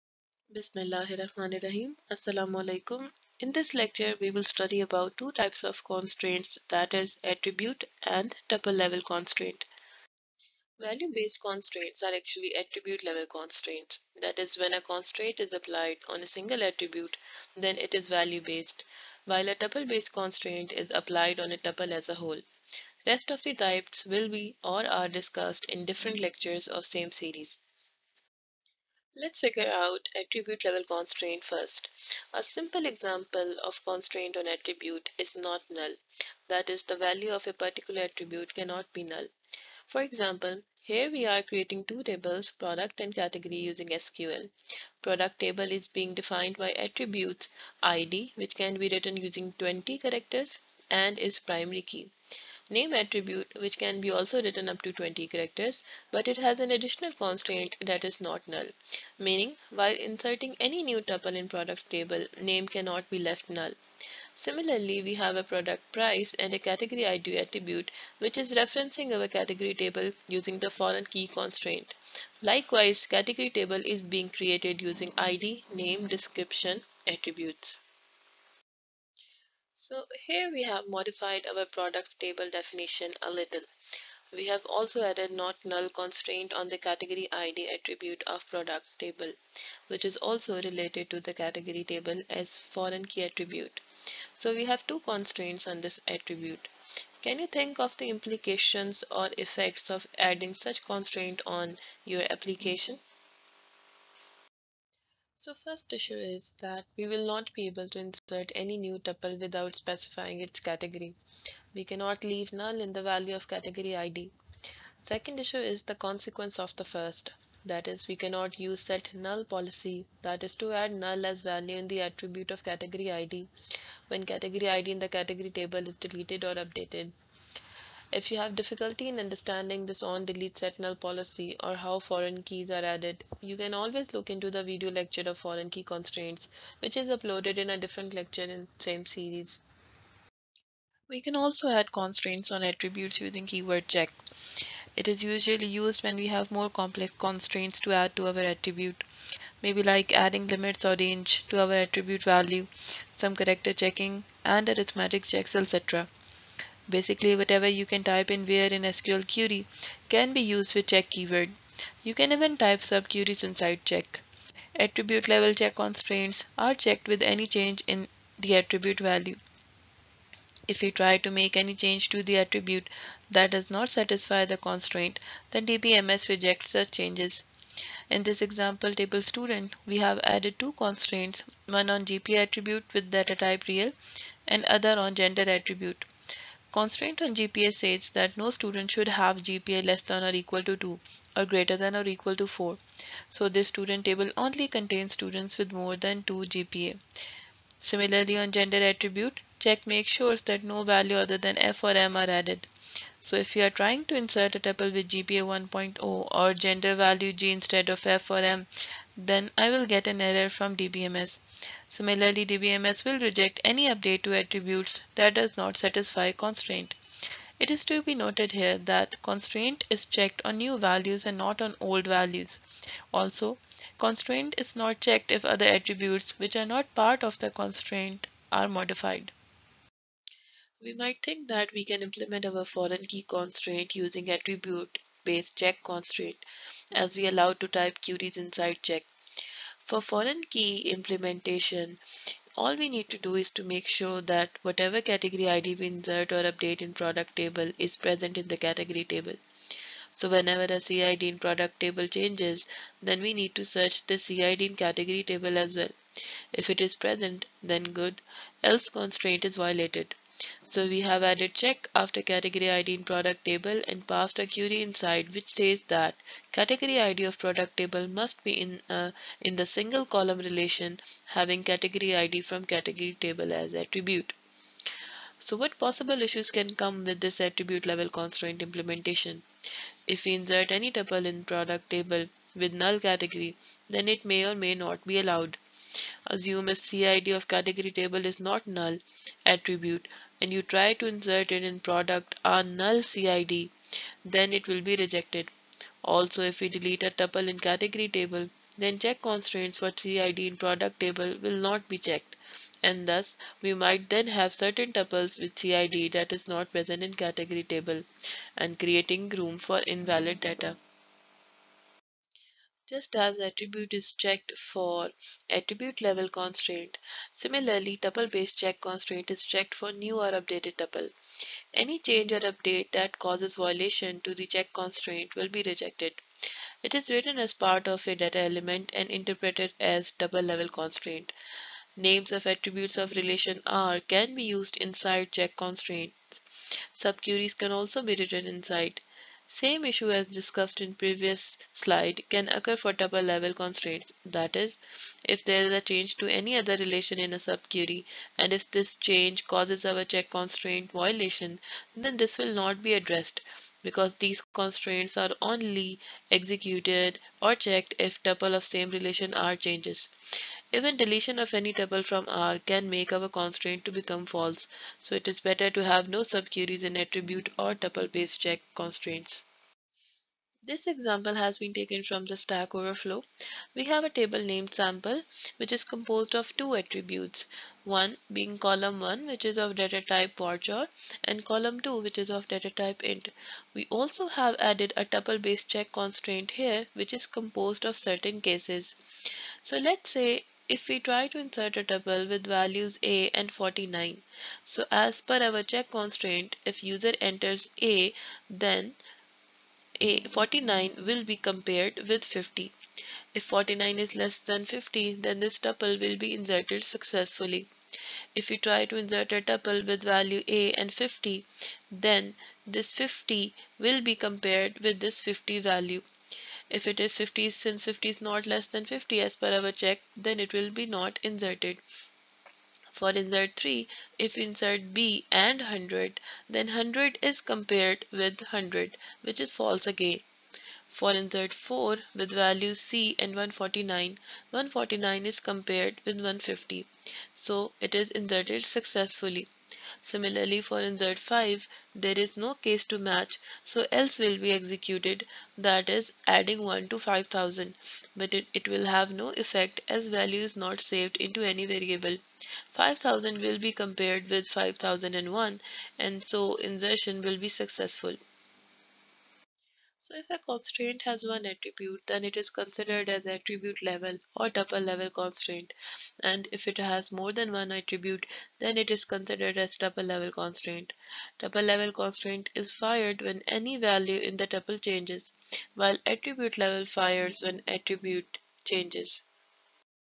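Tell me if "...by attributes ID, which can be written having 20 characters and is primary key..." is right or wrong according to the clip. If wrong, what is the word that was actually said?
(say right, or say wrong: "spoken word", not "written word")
wrong: "using", not "having".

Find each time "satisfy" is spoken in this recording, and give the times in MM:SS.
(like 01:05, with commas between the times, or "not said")
02:53, 03:35.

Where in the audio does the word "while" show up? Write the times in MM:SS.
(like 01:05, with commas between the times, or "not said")
00:19, 00:59, 07:55.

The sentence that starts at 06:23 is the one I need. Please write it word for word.
We also have added a tuple-based check constraint here, which is composed of certain cases.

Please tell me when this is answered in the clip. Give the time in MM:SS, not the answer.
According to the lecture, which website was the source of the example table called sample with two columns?
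06:12.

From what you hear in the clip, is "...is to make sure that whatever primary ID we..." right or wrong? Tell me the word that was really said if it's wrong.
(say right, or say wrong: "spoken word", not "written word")
wrong: "category", not "primary".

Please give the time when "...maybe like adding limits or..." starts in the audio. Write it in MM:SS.
02:29.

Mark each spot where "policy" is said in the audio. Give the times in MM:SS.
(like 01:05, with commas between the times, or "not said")
01:59, 02:10.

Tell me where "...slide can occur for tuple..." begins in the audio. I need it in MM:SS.
05:41.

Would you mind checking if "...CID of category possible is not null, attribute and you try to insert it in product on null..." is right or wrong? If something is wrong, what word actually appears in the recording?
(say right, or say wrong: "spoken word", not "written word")
wrong: "table", not "possible".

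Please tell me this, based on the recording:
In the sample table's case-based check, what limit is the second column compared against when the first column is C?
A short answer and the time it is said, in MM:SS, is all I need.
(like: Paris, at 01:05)
150, at 07:16.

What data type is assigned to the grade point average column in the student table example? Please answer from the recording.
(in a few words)
real.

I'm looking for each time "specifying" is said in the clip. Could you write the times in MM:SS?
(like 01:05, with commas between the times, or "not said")
01:49.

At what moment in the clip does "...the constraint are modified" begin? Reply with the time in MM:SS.
03:47.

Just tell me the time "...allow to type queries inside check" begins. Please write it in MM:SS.
03:57.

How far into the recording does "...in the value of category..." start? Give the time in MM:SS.
01:52.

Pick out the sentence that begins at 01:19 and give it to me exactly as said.
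So here we have modified our product table definition a little.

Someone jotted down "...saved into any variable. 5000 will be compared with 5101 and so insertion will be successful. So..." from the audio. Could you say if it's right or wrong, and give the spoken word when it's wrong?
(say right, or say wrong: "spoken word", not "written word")
wrong: "5001", not "5101".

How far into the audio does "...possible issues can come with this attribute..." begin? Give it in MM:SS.
04:35.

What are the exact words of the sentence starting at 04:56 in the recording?
Also, if we delete a tuple in category table, then check constraints for CID in product table will not be checked.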